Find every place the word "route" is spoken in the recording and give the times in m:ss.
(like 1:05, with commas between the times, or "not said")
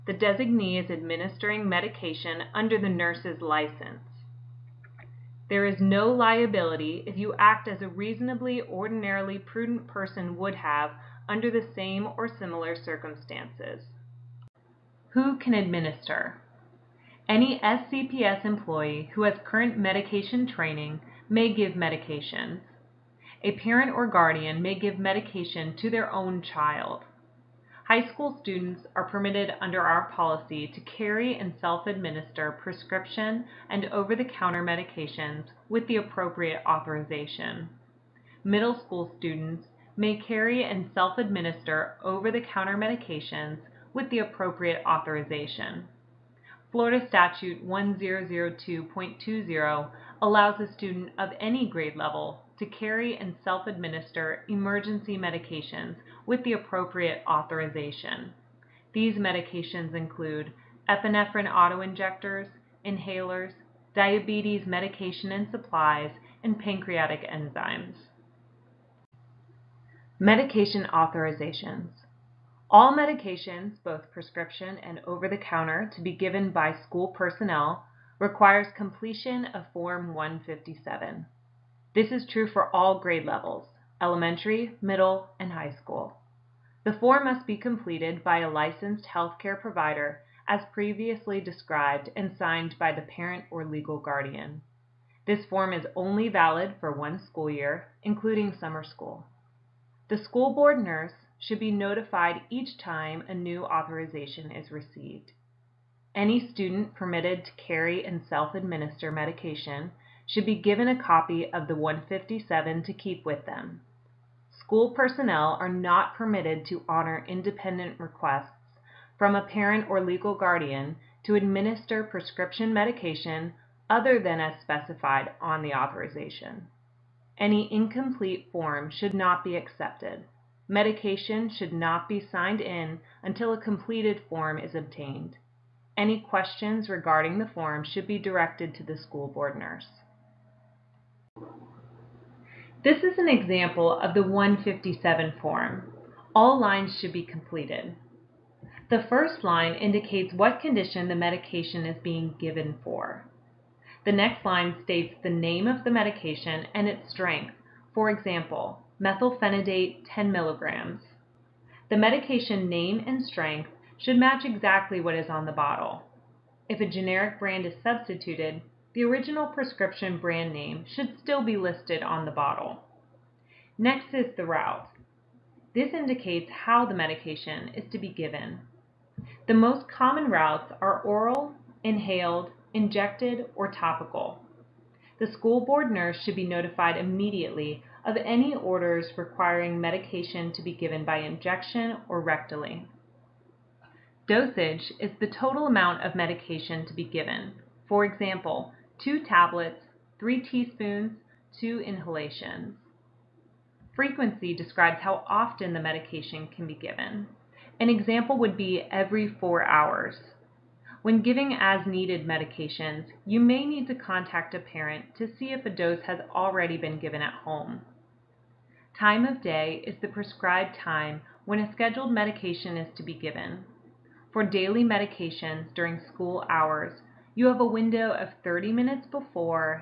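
2:54, 3:00.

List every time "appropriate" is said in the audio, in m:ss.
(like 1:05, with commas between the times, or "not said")
0:35, 0:44, 0:56.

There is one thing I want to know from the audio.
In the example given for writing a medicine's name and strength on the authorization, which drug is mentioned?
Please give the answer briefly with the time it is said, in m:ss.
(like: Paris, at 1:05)
methylphenidate, at 2:39.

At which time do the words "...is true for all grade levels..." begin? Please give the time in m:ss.
1:22.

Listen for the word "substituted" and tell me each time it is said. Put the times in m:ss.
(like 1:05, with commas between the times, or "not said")
2:47.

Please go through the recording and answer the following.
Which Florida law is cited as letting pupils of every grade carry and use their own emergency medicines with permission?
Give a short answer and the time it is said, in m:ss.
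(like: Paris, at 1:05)
Florida Statute 1002.20, at 0:46.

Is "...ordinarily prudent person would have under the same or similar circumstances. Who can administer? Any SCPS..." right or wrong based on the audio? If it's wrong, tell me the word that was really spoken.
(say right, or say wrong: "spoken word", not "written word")
right.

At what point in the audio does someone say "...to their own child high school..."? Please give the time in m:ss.
0:25.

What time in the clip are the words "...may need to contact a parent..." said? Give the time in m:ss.
3:33.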